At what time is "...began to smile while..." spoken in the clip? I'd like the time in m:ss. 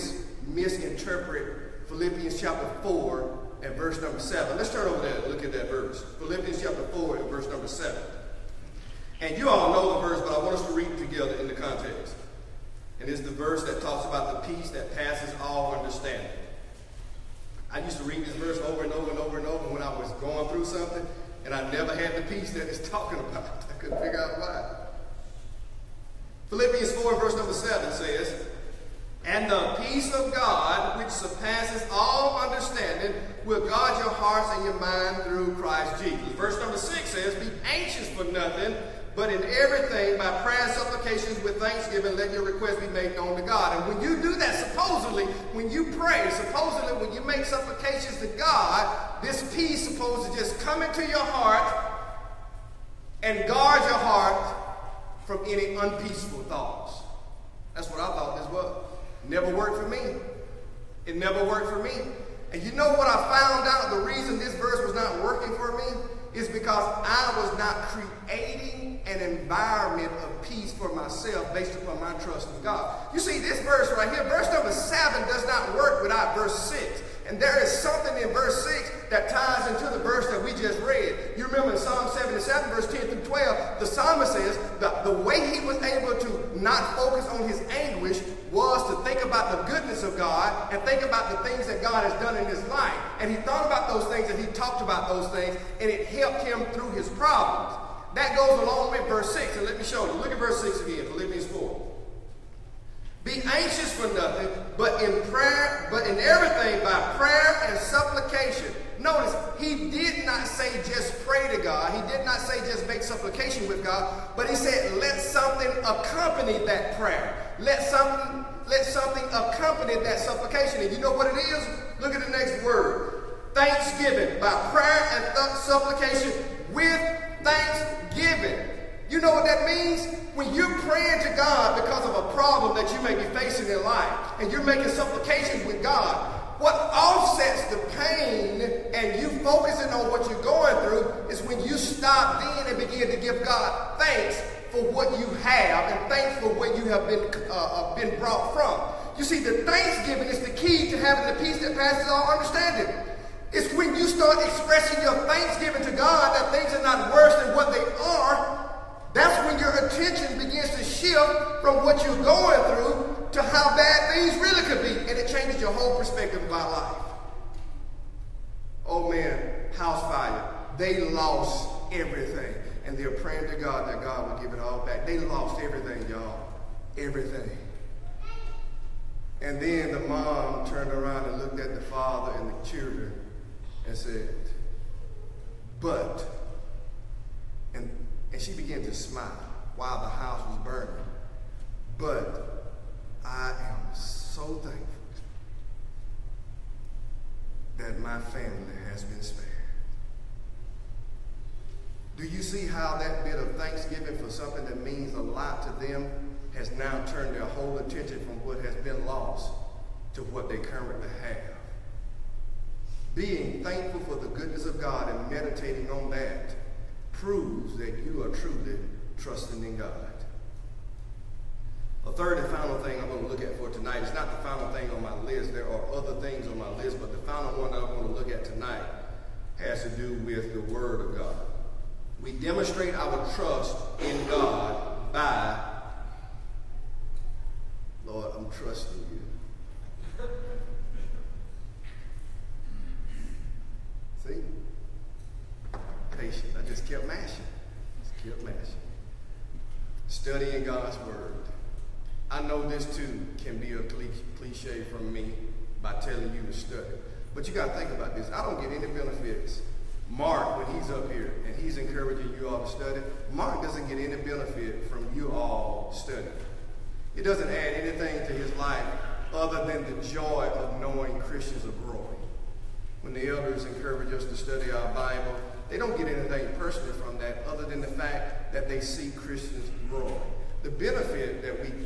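3:08.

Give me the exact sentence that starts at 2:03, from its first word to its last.
Thanksgiving by prayer and th supplication with thanksgiving.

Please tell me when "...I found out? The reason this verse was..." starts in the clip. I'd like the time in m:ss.
1:03.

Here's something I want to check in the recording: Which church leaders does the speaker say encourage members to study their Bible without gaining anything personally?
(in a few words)
The elders.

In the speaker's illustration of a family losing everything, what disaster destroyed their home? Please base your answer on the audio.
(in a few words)
House fire.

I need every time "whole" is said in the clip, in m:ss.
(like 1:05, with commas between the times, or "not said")
2:45, 3:27.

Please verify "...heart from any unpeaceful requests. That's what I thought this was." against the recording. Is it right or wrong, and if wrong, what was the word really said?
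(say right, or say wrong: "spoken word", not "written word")
wrong: "thoughts", not "requests".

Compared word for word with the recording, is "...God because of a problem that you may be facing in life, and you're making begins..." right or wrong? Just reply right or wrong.
wrong.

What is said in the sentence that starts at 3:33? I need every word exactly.
Being thankful for the goodness of God and meditating on that proves that you are truly trusting in God.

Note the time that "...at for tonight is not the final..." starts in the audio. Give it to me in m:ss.
3:43.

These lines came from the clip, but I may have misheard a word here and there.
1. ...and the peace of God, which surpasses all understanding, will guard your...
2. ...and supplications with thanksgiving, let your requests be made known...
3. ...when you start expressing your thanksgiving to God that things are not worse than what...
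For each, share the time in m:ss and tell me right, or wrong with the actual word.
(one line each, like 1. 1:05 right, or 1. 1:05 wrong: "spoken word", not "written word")
1. 0:29 right
2. 0:40 right
3. 2:33 right.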